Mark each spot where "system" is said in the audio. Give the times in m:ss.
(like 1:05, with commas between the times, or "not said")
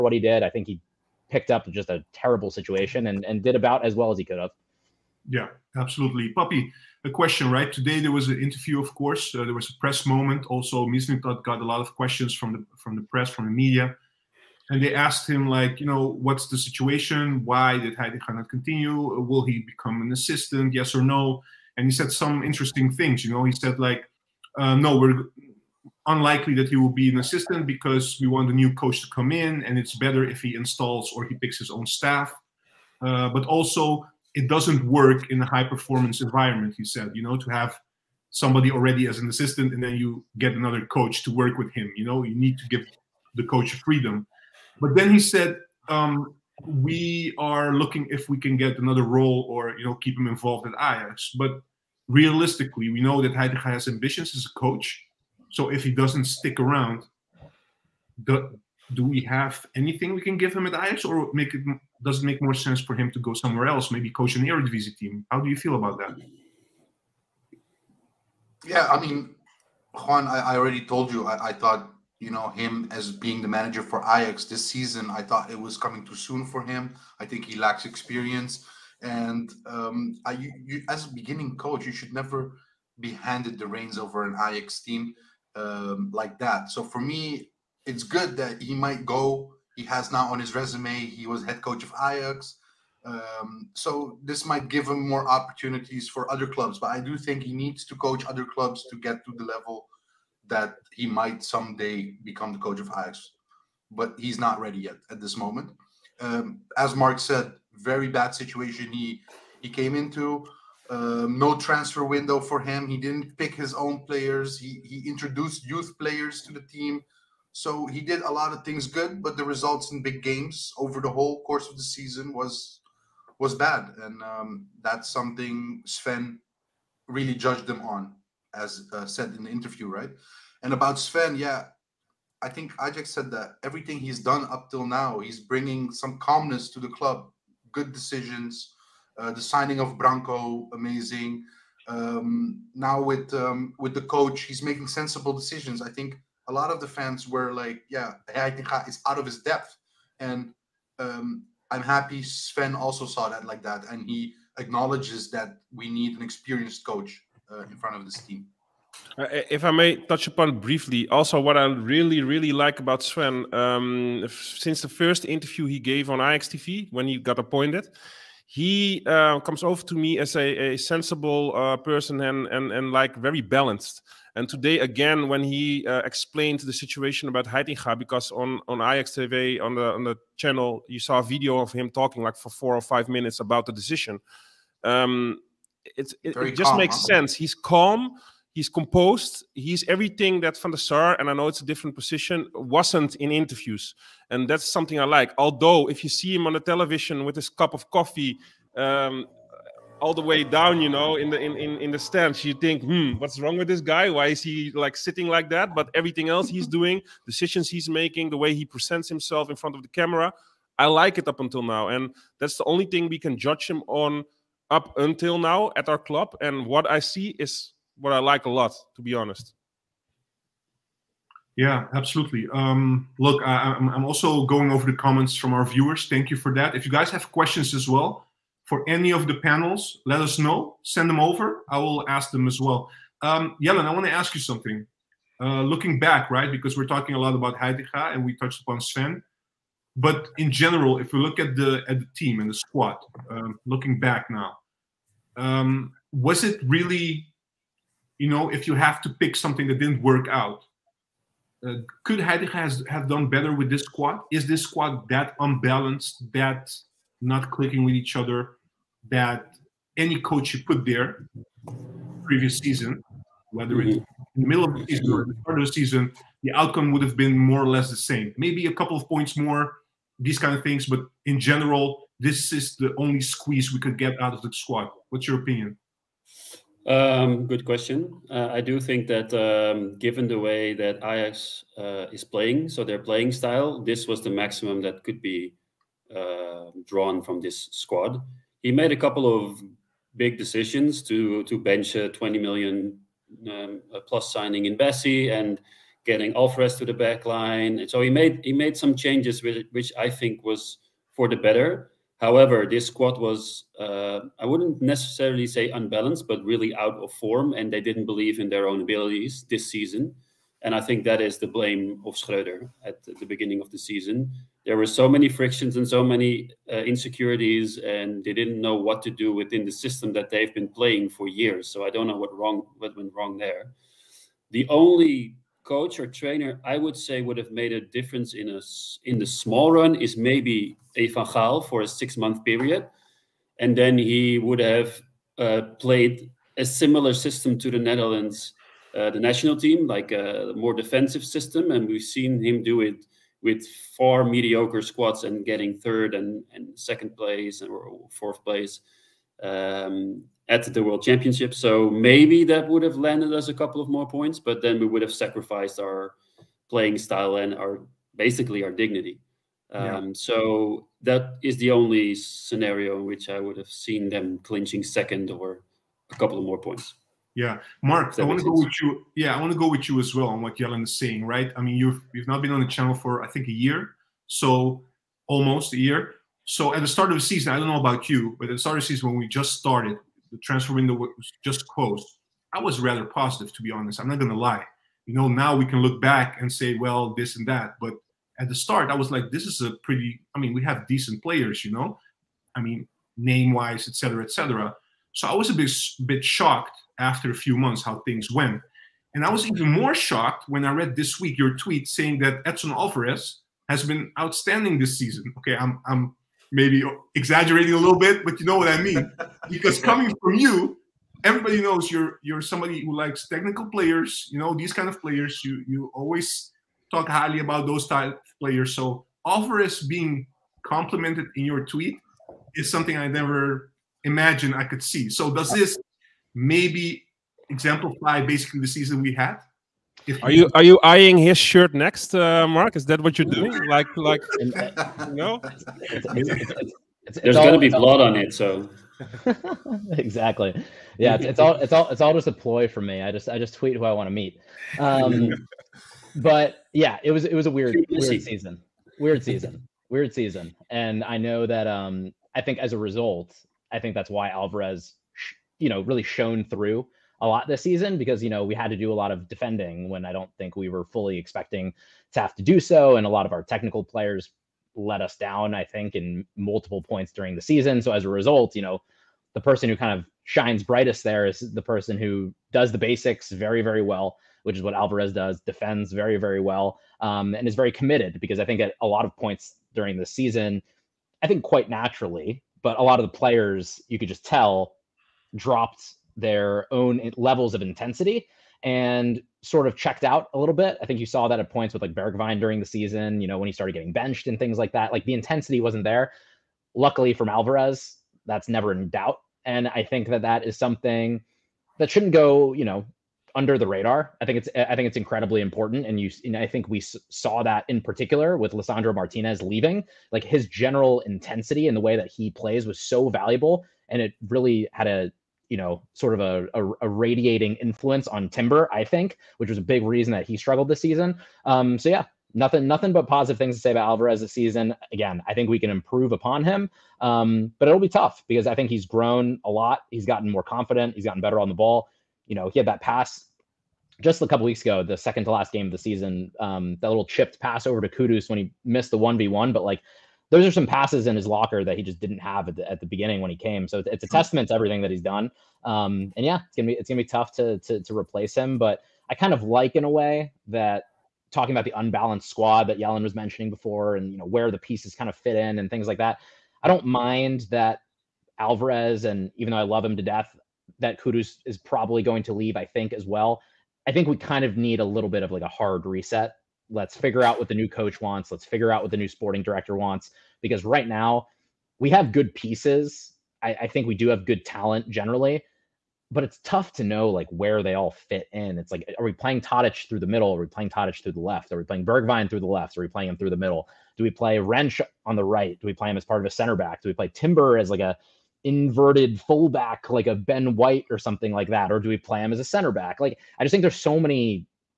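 5:19, 5:37, 5:41.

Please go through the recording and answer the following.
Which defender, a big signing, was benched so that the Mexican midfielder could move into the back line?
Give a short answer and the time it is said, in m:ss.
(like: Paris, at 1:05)
Bassey, at 4:54.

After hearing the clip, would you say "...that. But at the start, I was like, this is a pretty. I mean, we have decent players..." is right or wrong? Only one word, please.
right.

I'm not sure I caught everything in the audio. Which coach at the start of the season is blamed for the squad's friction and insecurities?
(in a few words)
Schreuder.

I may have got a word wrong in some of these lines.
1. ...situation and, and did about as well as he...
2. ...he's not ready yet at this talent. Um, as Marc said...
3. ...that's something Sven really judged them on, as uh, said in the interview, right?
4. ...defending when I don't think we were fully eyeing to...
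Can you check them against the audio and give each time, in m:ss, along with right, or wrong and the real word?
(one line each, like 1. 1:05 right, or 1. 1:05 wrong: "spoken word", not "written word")
1. 0:02 right
2. 1:44 wrong: "moment", not "talent"
3. 2:04 right
4. 7:39 wrong: "expecting", not "eyeing".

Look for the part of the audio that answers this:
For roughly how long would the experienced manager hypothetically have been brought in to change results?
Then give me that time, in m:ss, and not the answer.
5:31.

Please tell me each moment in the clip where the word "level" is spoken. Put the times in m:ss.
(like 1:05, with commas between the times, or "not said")
1:39, 8:07.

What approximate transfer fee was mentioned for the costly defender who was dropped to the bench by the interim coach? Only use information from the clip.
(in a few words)
20 million.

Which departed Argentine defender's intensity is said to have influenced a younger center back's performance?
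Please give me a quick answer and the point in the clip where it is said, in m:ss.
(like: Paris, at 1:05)
Lisandro Martinez, at 8:28.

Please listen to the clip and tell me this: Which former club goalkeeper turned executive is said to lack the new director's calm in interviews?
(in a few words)
Van der Sar.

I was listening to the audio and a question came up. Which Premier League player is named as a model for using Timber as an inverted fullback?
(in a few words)
Ben White.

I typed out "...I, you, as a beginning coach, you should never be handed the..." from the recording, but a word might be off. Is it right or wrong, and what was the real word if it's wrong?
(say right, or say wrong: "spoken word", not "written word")
right.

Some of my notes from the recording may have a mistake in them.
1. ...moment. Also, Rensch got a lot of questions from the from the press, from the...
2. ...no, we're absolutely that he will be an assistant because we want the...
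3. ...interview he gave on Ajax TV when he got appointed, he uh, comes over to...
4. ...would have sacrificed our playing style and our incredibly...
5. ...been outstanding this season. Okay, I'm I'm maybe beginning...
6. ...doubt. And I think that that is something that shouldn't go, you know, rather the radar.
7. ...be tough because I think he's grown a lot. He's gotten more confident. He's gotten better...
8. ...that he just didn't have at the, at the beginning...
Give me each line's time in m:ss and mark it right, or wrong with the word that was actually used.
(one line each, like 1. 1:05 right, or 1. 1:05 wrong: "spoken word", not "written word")
1. 0:10 wrong: "Mislintat", not "Rensch"
2. 0:24 wrong: "unlikely", not "absolutely"
3. 2:45 right
4. 5:54 wrong: "basically", not "incredibly"
5. 6:43 wrong: "exaggerating", not "beginning"
6. 8:18 wrong: "under", not "rather"
7. 8:47 right
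8. 9:01 right.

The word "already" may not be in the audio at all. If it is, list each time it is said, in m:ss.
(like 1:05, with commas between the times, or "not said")
0:38, 1:10.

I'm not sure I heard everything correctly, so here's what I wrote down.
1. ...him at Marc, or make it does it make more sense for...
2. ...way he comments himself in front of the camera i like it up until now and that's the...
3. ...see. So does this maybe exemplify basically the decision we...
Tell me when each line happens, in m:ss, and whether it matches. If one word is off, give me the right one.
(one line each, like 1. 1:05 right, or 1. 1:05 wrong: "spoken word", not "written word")
1. 1:00 wrong: "Ajax", not "Marc"
2. 3:28 wrong: "presents", not "comments"
3. 7:04 wrong: "season", not "decision".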